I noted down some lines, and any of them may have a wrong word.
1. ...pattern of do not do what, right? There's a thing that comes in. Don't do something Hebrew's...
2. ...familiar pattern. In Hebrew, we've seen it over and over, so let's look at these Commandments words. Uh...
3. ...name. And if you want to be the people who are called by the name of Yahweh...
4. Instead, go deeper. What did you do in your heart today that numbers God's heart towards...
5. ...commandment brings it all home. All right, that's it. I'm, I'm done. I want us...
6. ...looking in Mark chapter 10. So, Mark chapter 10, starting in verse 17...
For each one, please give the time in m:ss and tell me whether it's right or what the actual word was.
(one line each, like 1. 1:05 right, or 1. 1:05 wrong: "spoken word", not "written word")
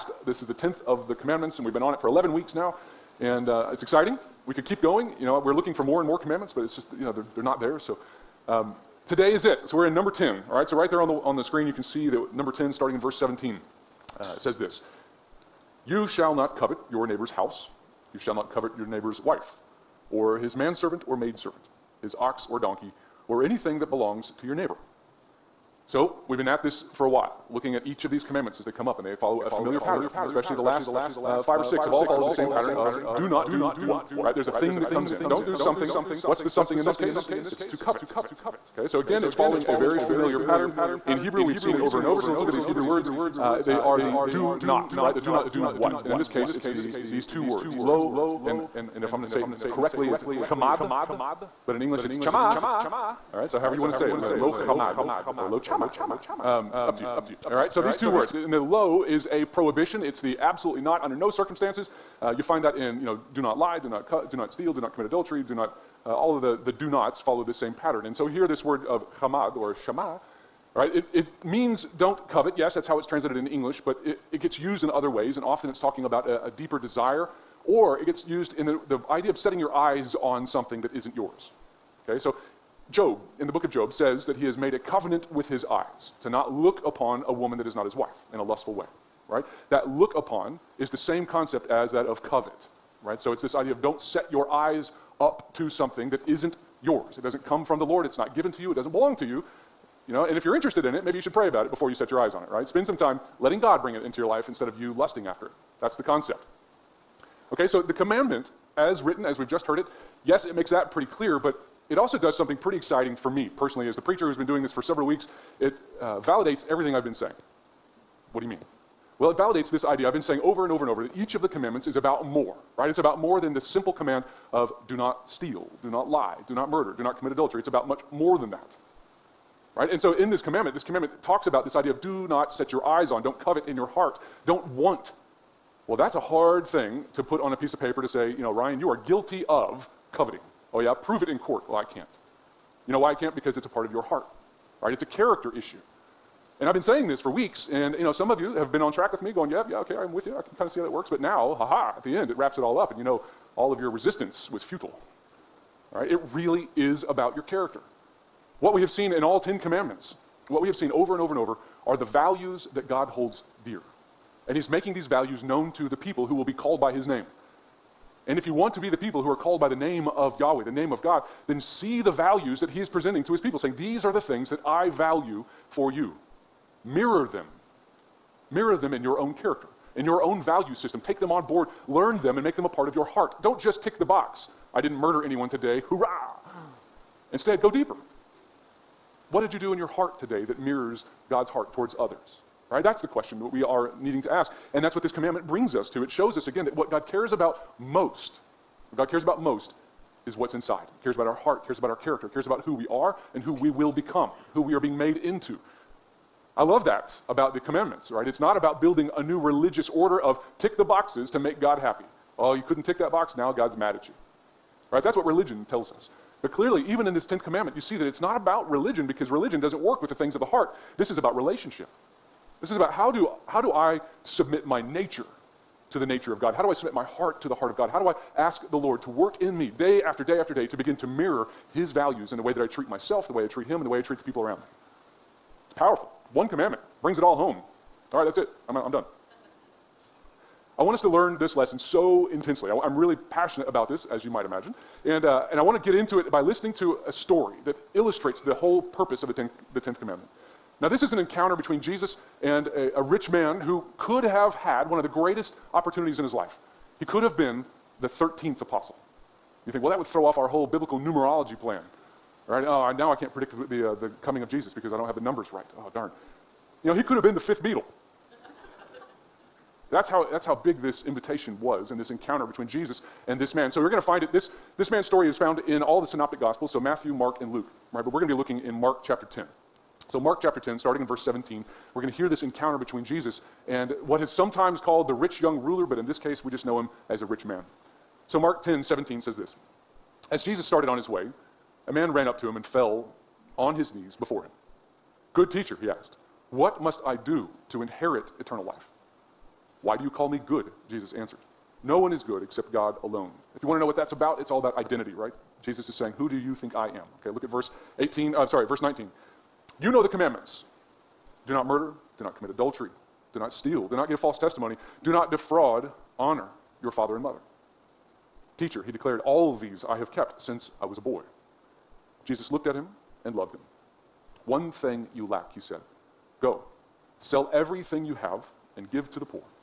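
1. 0:32 wrong: "What", not "Hebrew"
2. 0:39 wrong: "Hebrew", not "Commandments"
3. 2:47 right
4. 3:07 wrong: "mirrors", not "numbers"
5. 3:56 right
6. 4:38 right.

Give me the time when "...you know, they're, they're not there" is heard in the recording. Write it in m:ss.
0:06.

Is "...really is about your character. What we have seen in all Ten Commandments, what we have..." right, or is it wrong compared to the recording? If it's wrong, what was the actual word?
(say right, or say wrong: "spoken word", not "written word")
right.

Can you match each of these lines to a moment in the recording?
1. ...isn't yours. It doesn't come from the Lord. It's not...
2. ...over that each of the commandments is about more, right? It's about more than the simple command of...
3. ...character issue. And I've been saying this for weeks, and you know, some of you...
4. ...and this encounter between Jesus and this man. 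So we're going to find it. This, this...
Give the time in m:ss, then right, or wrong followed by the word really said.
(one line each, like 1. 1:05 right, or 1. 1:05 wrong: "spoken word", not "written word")
1. 1:36 right
2. 2:00 right
3. 2:25 right
4. 4:31 right.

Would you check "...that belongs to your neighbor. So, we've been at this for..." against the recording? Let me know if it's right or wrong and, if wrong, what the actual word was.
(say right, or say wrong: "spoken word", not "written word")
right.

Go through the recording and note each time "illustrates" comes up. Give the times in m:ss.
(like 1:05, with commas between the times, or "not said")
4:07.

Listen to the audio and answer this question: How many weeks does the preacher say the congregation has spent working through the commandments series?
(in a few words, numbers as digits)
11.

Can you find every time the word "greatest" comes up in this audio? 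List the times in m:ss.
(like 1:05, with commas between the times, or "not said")
4:15.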